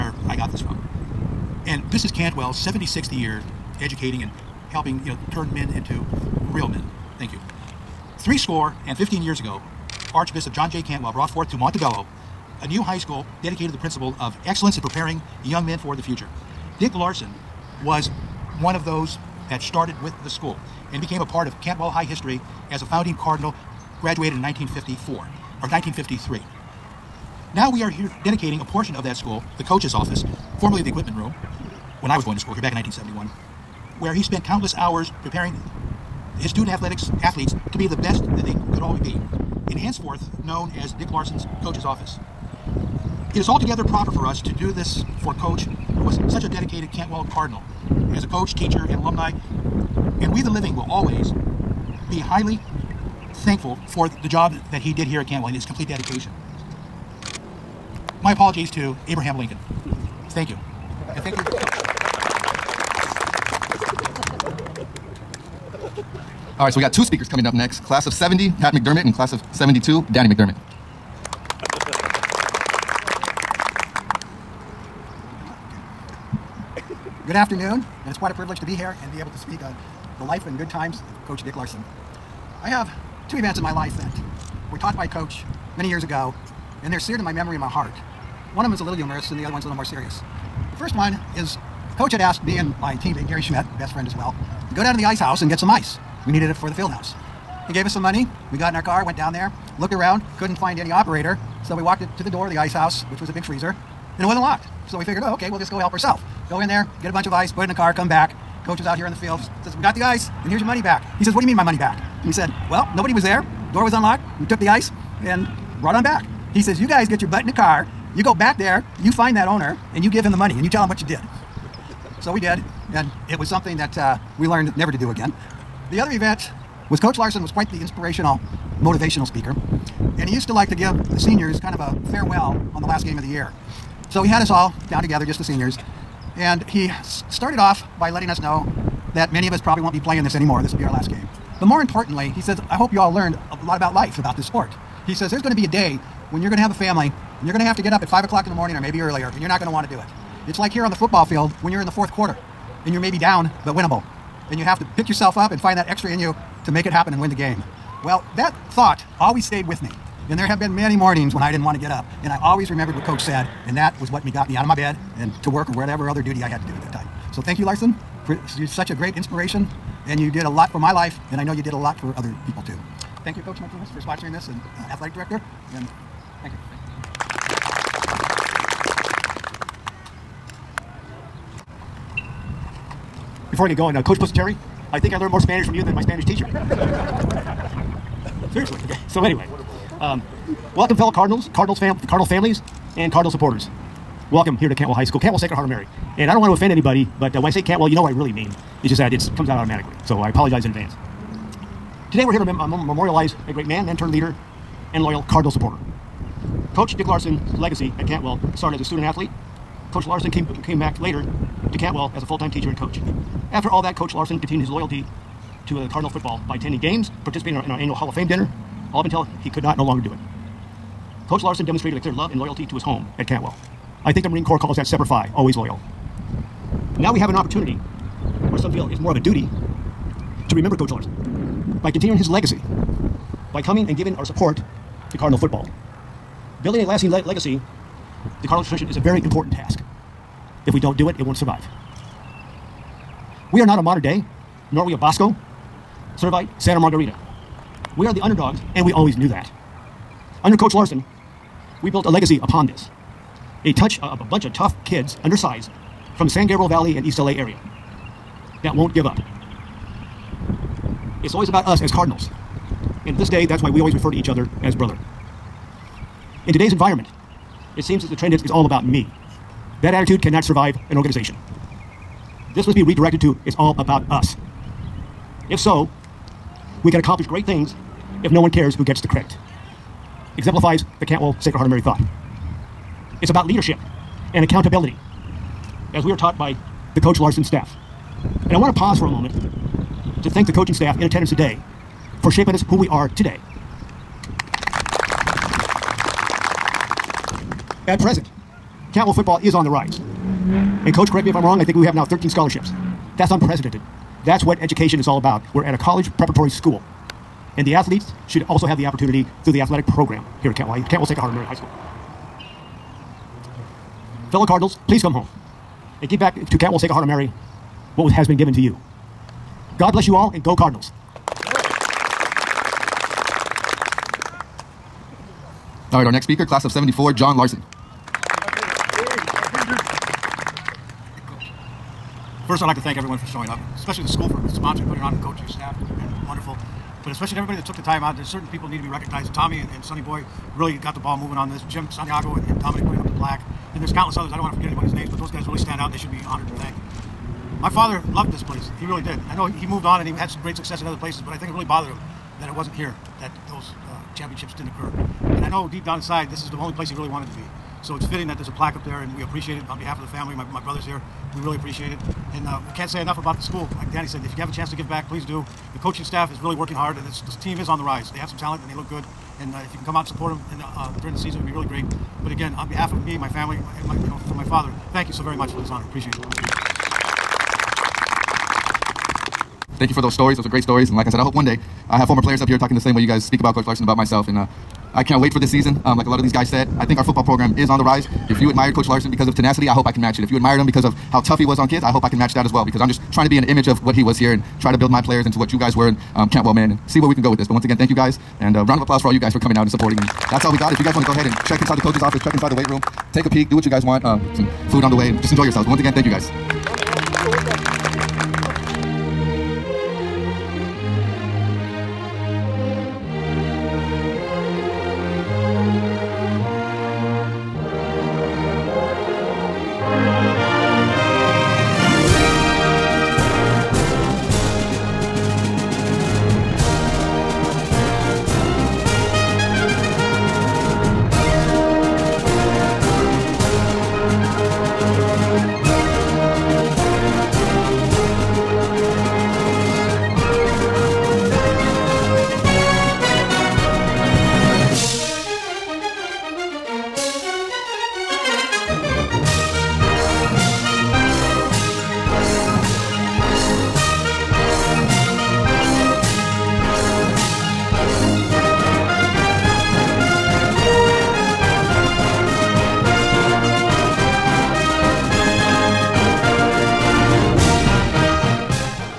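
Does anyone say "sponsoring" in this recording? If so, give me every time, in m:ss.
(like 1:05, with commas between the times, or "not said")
2:53, 5:34.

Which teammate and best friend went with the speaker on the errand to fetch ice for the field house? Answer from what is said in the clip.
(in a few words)
Gary Schmidt.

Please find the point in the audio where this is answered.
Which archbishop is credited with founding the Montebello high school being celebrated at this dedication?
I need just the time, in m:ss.
0:10.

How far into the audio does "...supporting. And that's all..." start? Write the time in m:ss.
6:39.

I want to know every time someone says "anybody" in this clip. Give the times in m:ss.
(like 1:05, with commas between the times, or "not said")
3:16, 5:44.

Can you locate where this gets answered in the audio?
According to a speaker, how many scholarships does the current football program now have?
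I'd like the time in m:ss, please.
5:02.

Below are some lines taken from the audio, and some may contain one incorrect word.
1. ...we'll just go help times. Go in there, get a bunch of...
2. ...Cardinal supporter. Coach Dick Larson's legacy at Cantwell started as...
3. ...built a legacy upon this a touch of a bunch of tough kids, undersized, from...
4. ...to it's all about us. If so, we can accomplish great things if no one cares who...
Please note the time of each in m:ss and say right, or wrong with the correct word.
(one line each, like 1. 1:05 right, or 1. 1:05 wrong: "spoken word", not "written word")
1. 1:45 wrong: "ourselves", not "times"
2. 3:25 right
3. 4:11 right
4. 4:33 right.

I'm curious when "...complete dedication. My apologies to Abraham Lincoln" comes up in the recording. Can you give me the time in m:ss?
0:55.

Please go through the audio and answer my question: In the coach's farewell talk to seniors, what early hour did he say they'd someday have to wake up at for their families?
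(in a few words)
5 o'clock.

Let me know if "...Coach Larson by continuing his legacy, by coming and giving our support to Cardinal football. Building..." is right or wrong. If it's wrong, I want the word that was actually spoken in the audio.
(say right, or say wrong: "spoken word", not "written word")
right.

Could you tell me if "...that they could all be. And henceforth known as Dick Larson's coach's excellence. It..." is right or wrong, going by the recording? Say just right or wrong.
wrong.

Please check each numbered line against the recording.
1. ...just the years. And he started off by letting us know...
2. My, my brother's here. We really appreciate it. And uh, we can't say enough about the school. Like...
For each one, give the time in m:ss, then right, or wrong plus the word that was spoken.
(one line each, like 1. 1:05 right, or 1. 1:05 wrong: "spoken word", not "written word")
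1. 2:15 wrong: "seniors", not "years"
2. 6:00 right.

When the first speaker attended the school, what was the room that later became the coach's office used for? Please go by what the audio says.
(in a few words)
equipment room.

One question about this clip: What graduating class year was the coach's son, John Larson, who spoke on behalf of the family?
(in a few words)
74.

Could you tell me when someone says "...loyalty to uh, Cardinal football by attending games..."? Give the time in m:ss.
3:34.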